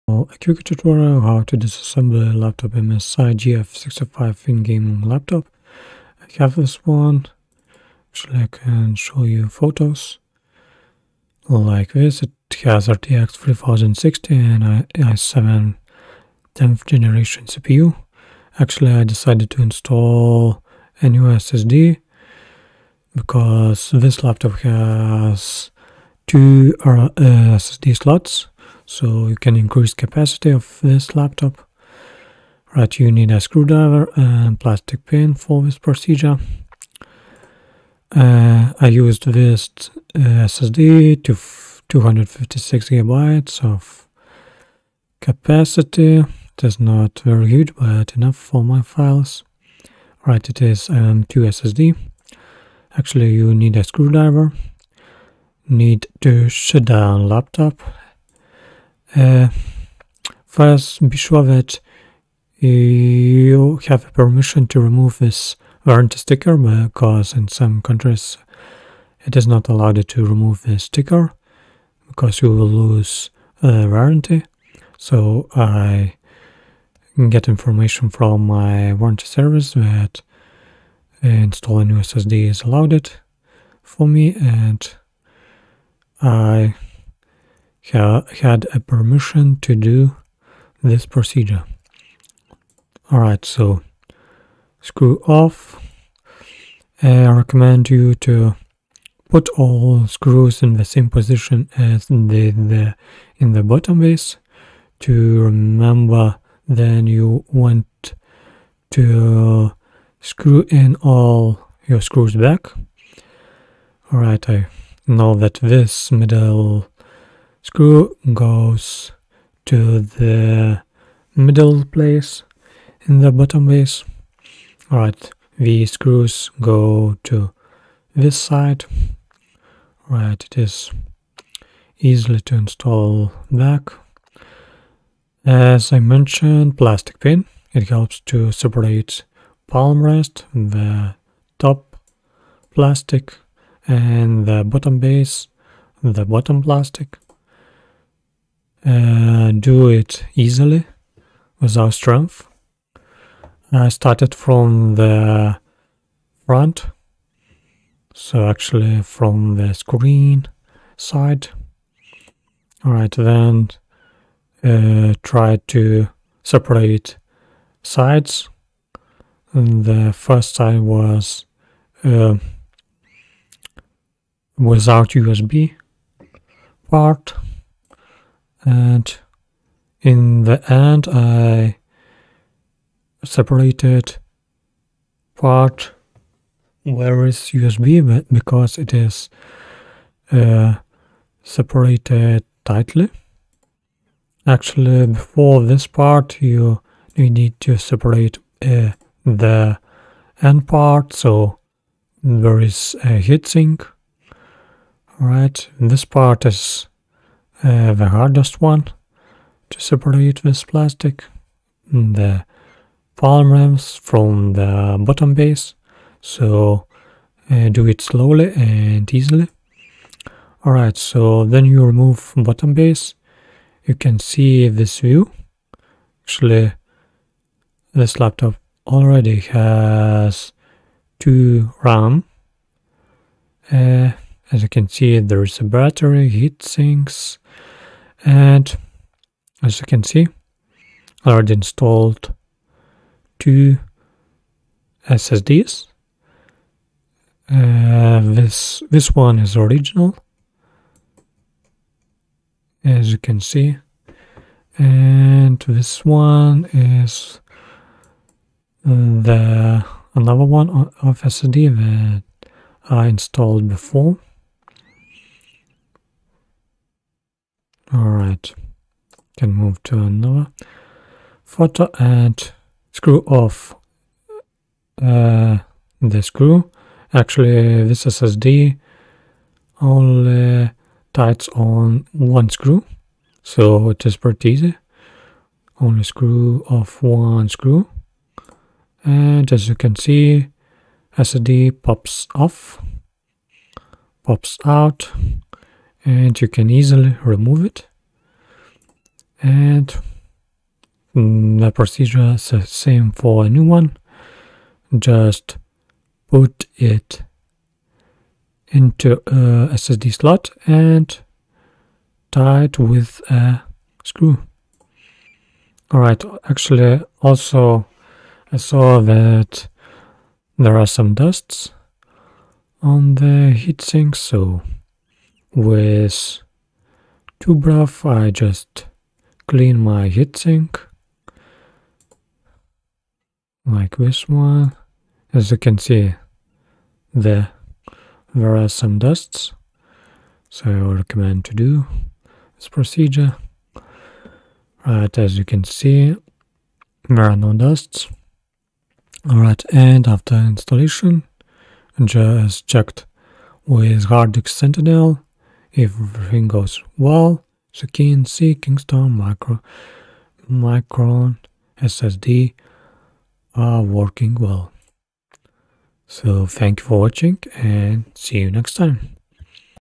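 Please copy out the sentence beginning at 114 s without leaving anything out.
Alright, I know that this middle screw goes to the middle place in the bottom base.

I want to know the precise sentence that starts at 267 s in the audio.
All right, can move to another photo and screw off uh, the screw.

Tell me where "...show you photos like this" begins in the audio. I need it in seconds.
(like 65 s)
8 s.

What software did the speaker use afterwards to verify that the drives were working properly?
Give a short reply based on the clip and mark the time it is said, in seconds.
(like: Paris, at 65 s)
Hard Disk Sentinel, at 354 s.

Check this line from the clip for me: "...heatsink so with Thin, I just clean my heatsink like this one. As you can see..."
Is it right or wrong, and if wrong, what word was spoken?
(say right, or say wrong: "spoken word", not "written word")
wrong: "Tubruff", not "Thin".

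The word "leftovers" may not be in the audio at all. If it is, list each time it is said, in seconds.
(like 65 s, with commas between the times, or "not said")
not said.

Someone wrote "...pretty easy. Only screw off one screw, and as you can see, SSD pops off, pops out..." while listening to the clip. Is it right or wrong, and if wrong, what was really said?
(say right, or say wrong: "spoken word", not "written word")
right.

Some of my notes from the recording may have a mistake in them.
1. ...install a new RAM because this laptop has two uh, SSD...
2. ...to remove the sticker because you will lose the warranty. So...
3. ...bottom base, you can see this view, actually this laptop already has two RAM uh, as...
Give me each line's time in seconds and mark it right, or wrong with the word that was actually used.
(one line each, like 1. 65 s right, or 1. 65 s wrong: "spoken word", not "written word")
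1. 19 s wrong: "SSD", not "RAM"
2. 70 s right
3. 222 s right.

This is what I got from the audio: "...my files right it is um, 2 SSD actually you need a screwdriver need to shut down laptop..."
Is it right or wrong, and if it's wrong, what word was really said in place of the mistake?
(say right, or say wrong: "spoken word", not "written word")
right.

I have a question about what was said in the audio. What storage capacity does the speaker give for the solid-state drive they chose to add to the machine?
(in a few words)
256 GB.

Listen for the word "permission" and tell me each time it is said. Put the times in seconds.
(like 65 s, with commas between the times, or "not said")
64 s, 88 s.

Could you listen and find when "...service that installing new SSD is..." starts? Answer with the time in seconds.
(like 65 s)
79 s.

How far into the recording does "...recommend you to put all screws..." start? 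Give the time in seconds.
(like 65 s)
97 s.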